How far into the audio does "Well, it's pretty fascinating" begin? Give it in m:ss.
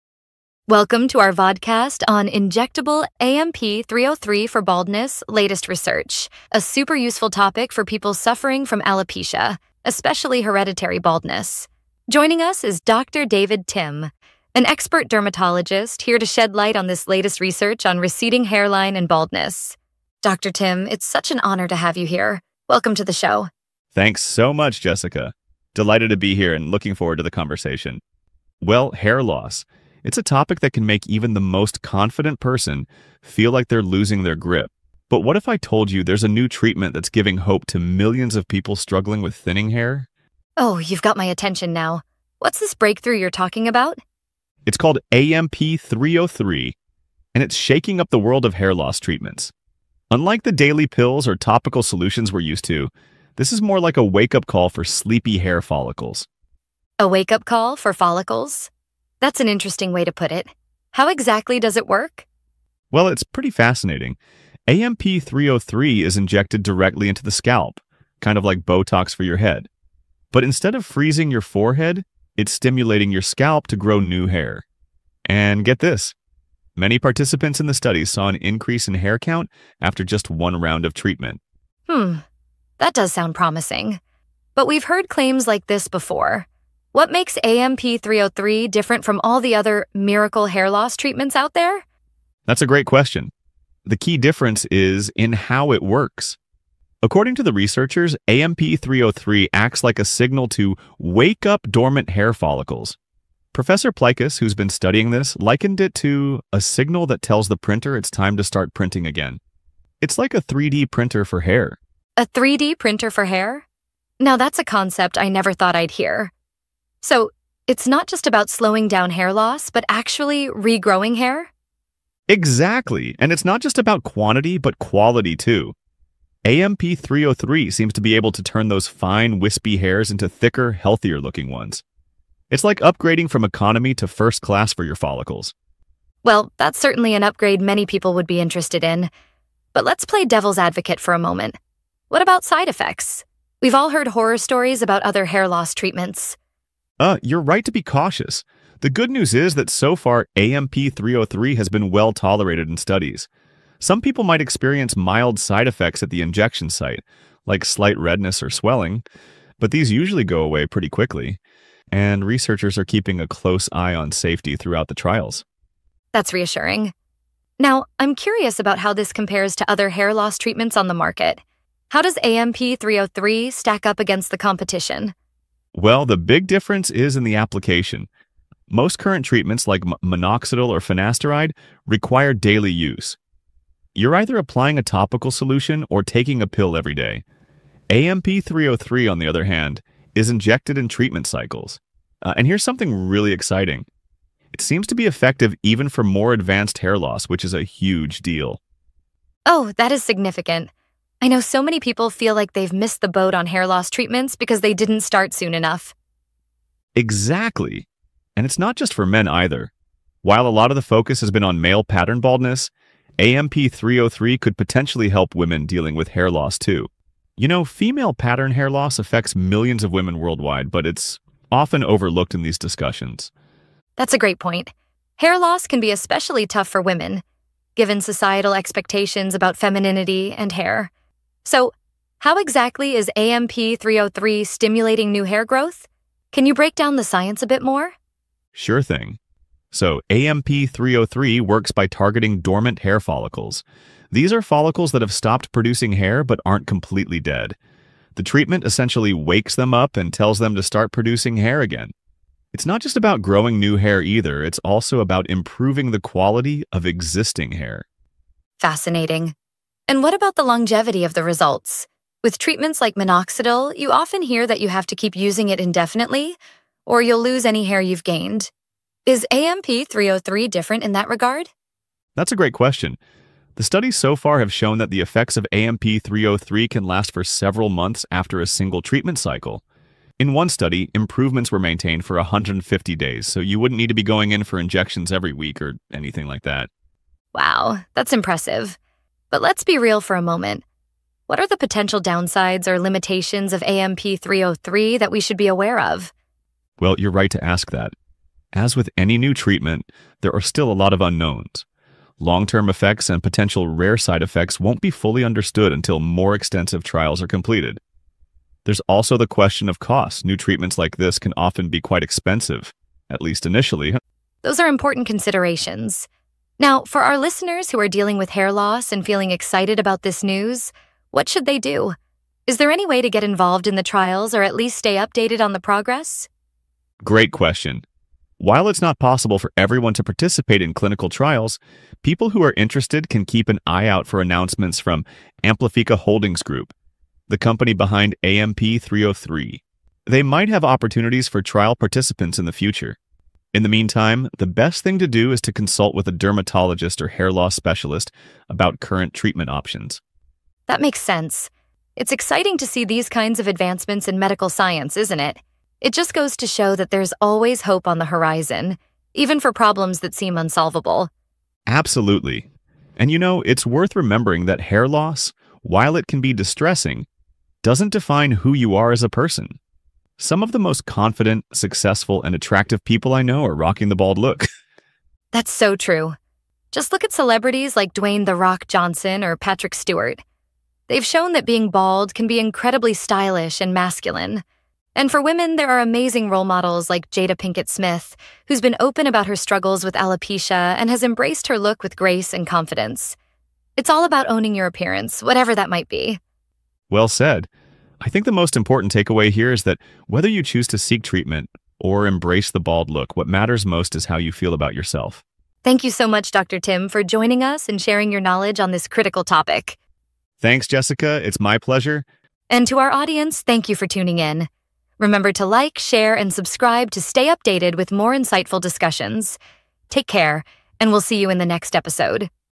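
1:02.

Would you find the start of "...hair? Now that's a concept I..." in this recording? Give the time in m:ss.
1:53.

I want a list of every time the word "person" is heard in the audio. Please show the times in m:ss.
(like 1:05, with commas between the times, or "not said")
0:32, 6:09.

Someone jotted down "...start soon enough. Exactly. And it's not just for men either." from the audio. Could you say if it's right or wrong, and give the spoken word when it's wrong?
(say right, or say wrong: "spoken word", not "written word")
right.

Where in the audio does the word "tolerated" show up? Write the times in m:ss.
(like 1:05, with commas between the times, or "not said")
2:32.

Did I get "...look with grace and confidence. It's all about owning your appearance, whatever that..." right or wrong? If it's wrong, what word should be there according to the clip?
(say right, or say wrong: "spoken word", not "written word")
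right.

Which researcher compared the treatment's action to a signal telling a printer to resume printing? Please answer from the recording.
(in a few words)
Professor Plikus.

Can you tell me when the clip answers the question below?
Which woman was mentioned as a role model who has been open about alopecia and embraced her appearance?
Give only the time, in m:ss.
6:27.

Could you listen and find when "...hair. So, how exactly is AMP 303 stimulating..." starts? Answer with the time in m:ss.
3:50.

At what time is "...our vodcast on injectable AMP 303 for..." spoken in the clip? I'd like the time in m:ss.
0:01.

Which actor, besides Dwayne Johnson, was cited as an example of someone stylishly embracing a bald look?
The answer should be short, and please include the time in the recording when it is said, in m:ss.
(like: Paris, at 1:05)
Patrick Stewart, at 6:19.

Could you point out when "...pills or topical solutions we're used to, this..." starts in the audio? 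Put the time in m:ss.
0:50.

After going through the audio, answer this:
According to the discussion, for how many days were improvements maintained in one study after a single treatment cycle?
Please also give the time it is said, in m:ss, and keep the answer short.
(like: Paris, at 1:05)
150, at 4:42.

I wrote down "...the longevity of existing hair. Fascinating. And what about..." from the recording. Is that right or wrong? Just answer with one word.
wrong.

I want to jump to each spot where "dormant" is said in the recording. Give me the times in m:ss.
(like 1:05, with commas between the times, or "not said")
1:41, 4:02.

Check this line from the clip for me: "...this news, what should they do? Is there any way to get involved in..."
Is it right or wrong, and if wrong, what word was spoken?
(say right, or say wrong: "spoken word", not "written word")
right.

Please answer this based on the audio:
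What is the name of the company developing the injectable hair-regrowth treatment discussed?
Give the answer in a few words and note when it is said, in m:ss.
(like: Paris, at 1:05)
Amplifica Holdings Group, at 5:35.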